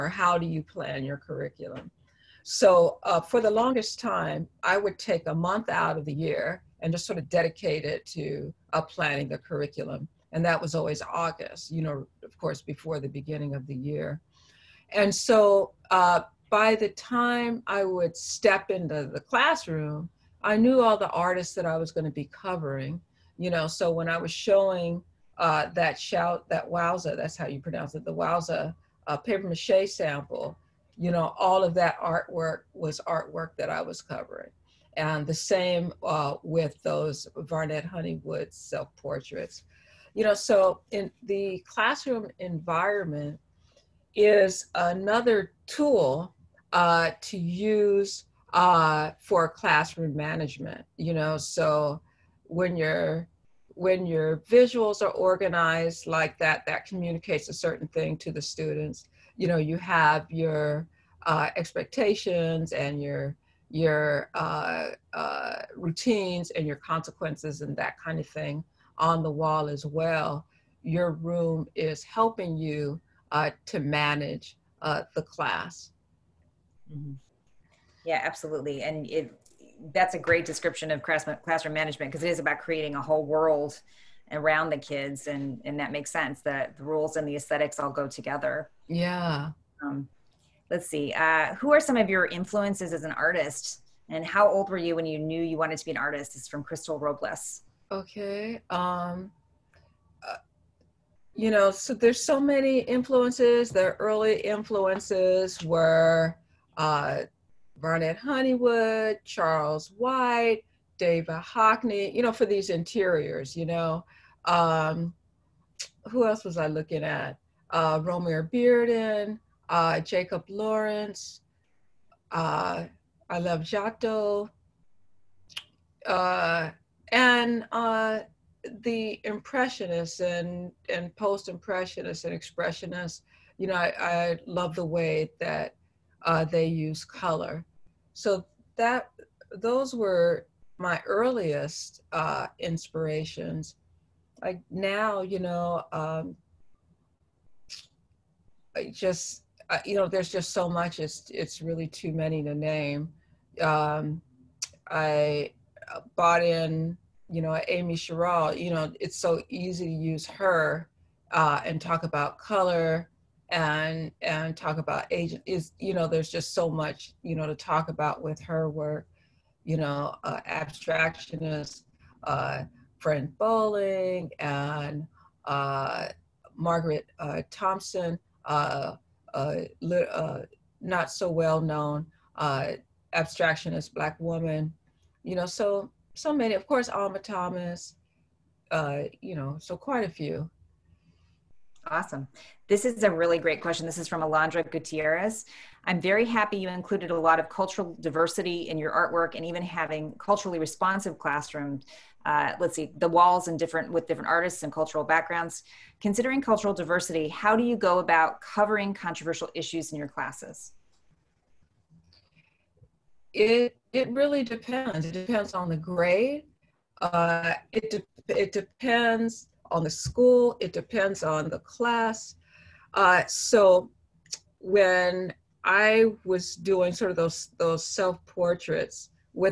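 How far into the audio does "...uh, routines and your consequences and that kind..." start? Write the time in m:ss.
1:05.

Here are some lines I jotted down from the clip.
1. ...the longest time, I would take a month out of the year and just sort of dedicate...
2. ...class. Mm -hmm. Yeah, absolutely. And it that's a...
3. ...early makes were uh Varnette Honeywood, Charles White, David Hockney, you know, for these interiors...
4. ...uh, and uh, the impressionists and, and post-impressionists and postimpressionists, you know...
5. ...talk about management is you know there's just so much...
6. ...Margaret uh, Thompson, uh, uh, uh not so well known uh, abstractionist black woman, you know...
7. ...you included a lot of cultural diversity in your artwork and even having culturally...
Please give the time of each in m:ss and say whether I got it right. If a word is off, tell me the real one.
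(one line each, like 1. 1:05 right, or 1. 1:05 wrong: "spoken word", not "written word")
1. 0:03 right
2. 1:15 right
3. 1:43 wrong: "influences", not "makes"
4. 2:06 wrong: "expressionists", not "postimpressionists"
5. 2:44 wrong: "agent", not "management"
6. 2:56 right
7. 3:16 right.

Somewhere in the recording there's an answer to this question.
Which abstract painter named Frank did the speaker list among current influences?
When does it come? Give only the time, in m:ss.
2:52.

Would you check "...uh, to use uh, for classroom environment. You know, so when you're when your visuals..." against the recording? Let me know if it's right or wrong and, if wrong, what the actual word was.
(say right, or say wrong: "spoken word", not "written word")
wrong: "management", not "environment".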